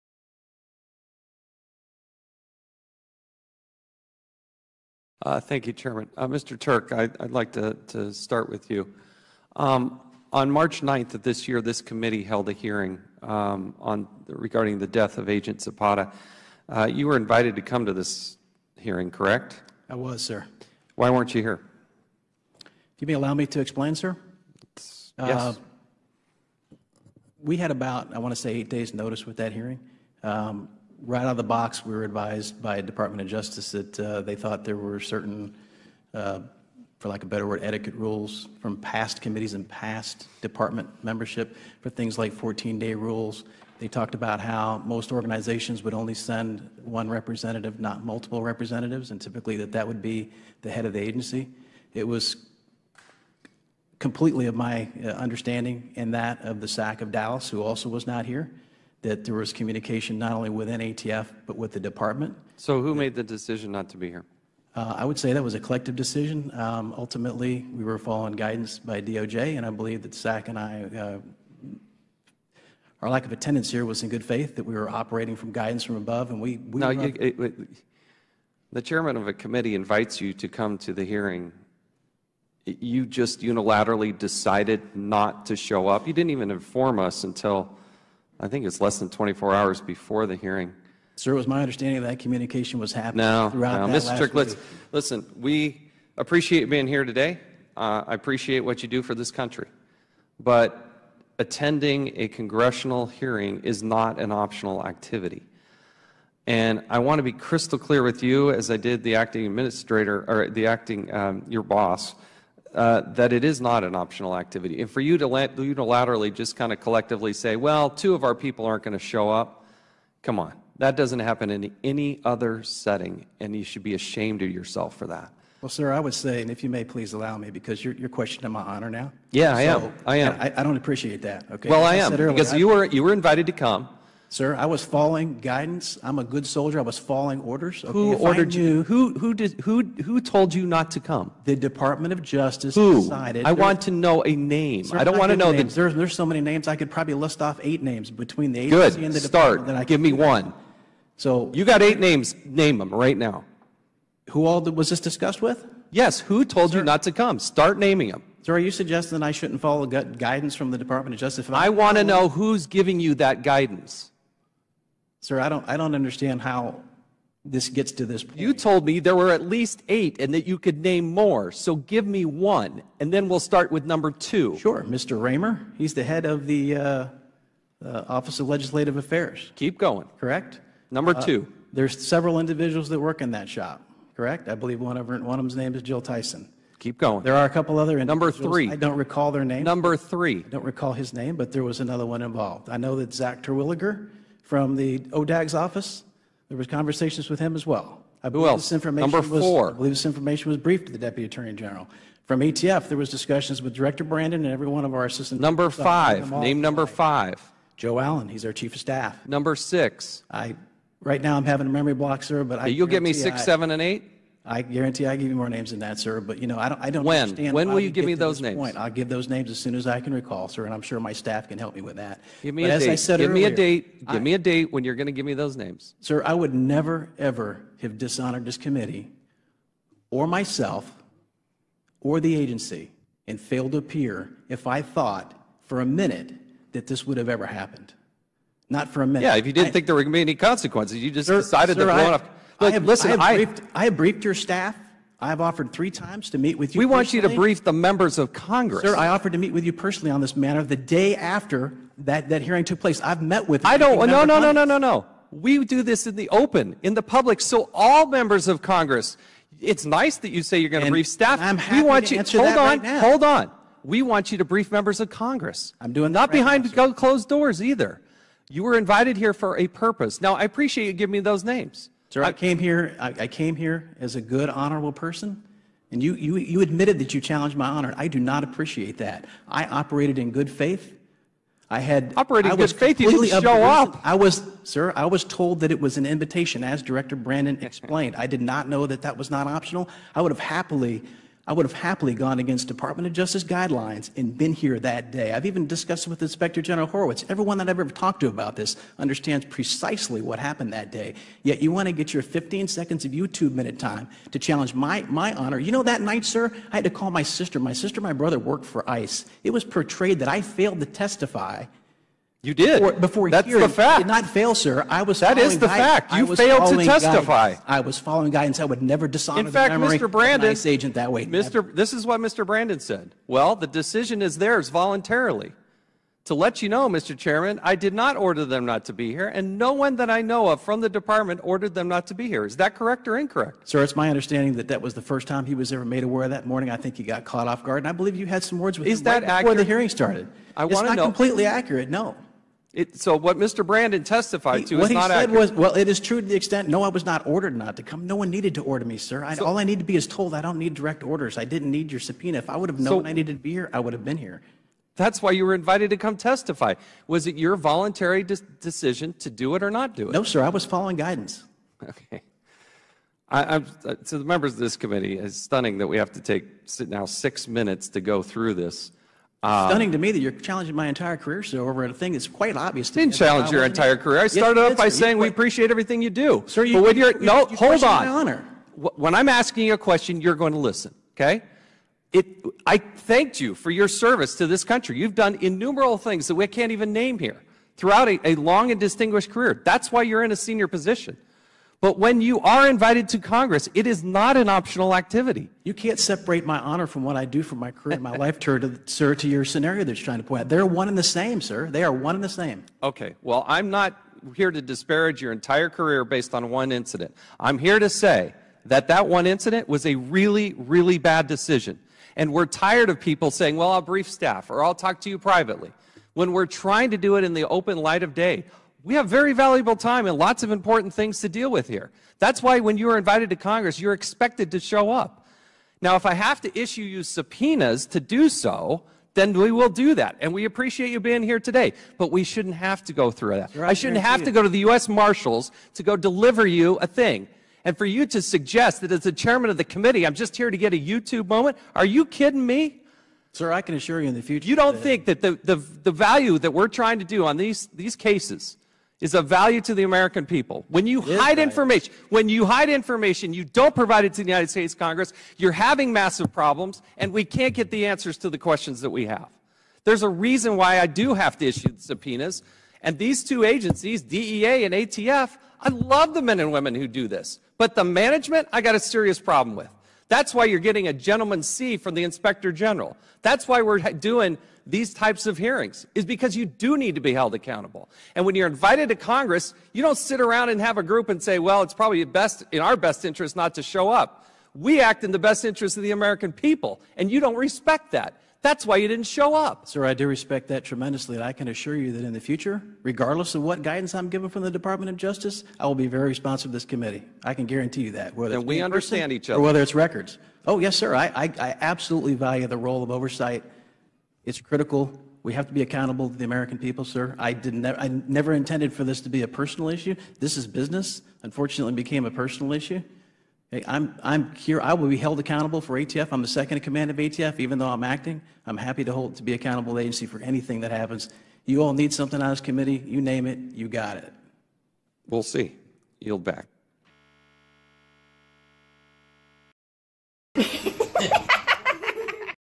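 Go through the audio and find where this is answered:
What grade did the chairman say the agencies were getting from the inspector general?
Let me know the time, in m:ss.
7:50.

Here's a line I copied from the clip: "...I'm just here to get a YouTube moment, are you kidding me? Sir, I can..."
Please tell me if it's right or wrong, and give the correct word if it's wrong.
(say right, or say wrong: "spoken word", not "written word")
right.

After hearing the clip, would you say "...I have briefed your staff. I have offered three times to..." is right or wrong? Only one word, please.
right.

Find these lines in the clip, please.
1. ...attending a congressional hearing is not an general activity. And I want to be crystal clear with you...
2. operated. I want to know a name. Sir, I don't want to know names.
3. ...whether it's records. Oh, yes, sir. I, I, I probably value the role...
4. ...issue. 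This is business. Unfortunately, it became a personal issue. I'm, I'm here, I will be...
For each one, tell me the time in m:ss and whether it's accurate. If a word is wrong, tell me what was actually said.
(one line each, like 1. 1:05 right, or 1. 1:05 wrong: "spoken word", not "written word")
1. 1:41 wrong: "optional", not "general"
2. 2:23 wrong: "decided", not "operated"
3. 8:19 wrong: "absolutely", not "probably"
4. 8:29 right.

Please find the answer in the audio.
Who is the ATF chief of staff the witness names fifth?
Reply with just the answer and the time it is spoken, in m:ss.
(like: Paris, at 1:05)
Joe Allen, at 3:27.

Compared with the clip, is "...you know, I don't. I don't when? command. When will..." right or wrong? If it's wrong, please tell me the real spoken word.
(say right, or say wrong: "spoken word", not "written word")
wrong: "understand", not "command".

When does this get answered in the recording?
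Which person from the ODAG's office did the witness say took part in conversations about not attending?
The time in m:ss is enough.
3:13.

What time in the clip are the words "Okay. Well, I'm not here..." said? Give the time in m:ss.
6:42.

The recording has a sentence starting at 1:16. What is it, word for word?
we you, it, it, the chairman of a committee invites you to come to the hearing.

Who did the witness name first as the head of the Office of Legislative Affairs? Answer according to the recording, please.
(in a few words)
Mr. Ramer.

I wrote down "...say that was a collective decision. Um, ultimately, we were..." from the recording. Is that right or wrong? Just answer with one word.
right.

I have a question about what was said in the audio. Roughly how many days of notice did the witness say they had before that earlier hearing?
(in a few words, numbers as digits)
8 days.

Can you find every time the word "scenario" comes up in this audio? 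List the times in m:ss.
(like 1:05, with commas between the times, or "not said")
6:39.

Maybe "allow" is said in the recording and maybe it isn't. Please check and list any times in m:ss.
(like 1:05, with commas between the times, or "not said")
0:23, 2:07.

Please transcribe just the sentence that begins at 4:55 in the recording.
I've even discussed it with Inspector General Horowitz.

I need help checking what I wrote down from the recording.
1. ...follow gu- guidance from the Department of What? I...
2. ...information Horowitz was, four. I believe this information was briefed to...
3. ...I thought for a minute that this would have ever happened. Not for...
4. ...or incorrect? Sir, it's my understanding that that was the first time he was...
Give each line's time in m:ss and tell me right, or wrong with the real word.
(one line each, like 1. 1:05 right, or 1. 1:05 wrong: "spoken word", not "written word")
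1. 2:39 wrong: "Justice", not "What"
2. 3:18 wrong: "Number", not "Horowitz"
3. 3:54 right
4. 5:33 right.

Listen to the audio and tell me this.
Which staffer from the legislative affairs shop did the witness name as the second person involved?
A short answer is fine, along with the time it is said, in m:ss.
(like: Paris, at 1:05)
Jill Tyson, at 3:05.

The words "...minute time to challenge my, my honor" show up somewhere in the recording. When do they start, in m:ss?
5:03.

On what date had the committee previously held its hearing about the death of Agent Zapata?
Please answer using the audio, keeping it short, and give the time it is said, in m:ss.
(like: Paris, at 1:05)
March 9th, at 0:10.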